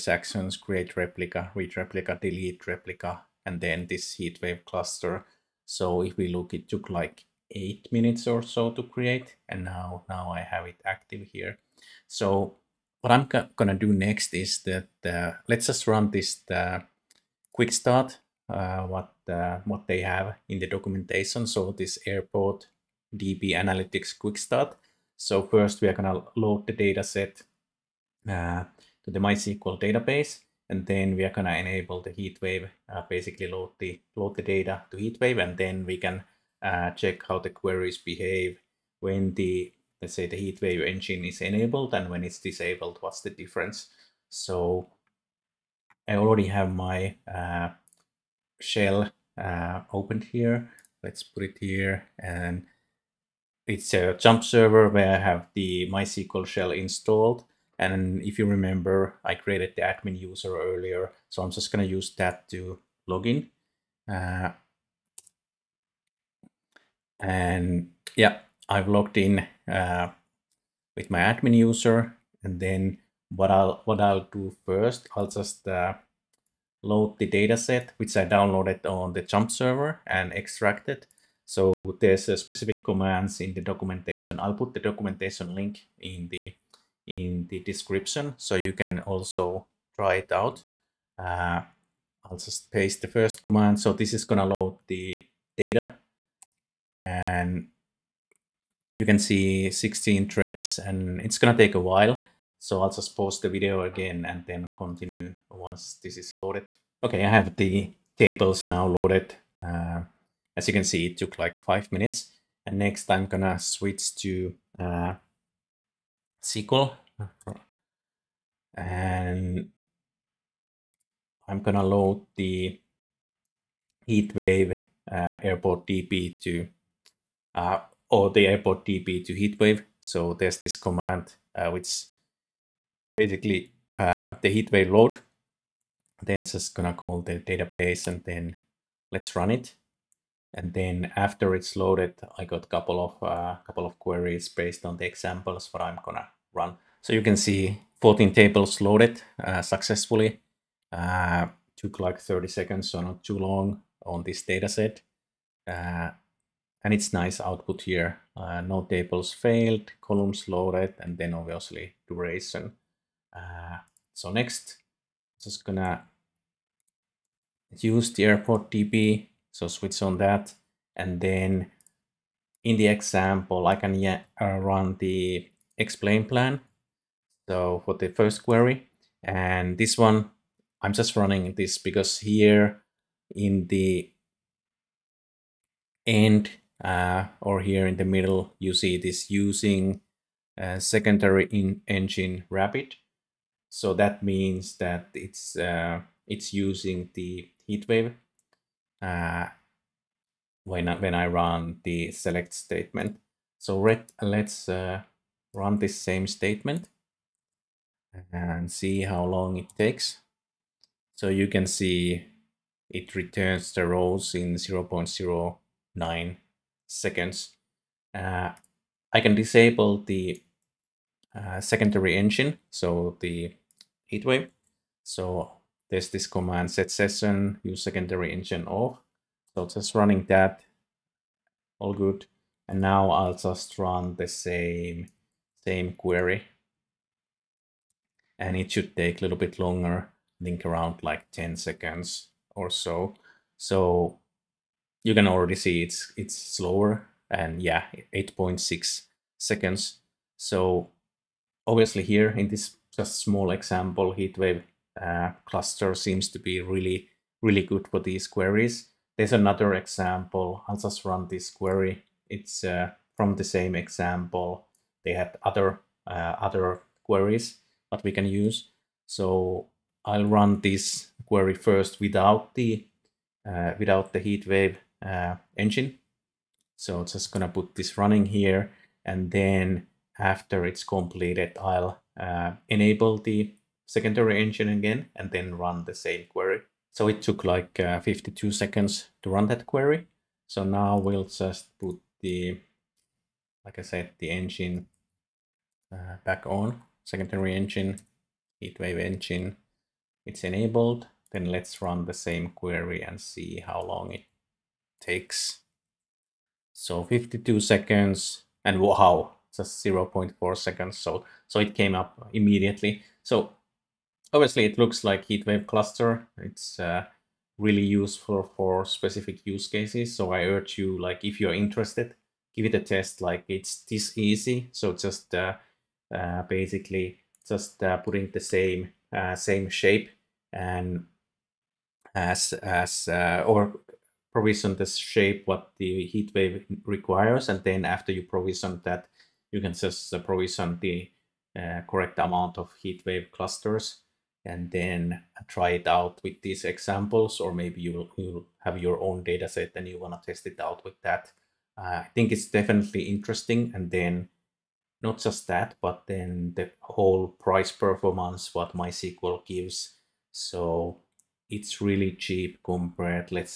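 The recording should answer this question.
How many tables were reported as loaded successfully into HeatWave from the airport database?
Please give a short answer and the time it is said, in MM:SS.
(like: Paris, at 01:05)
14, at 02:28.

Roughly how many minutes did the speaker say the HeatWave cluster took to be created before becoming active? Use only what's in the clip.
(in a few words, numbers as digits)
8 minutes.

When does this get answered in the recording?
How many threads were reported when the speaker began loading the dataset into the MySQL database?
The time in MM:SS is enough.
01:39.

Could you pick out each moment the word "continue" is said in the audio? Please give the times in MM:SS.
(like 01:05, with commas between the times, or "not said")
01:44.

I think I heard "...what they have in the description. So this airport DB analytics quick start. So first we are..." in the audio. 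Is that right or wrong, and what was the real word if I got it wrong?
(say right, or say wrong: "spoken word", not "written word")
wrong: "documentation", not "description".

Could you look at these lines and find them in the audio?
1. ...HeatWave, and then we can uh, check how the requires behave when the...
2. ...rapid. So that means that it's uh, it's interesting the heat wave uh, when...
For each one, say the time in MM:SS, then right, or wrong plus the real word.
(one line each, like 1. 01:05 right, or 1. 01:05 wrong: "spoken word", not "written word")
1. 00:34 wrong: "queries", not "requires"
2. 03:12 wrong: "using", not "interesting".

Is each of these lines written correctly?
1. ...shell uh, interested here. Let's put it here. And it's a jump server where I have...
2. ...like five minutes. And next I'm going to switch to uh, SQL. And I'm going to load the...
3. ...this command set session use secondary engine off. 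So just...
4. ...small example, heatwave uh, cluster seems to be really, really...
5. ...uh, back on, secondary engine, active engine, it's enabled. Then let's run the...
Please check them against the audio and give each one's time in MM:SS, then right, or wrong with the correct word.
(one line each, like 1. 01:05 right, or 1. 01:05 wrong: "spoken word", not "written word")
1. 00:48 wrong: "opened", not "interested"
2. 01:51 right
3. 03:46 right
4. 04:13 right
5. 04:55 wrong: "heatwave", not "active".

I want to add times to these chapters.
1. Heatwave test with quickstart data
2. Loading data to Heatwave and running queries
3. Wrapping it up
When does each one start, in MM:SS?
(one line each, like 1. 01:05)
1. 00:19
2. 02:09
3. 05:27.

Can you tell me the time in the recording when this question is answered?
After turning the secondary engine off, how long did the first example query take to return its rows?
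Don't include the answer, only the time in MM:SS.
04:08.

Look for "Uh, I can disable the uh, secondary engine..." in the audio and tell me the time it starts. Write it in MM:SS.
03:38.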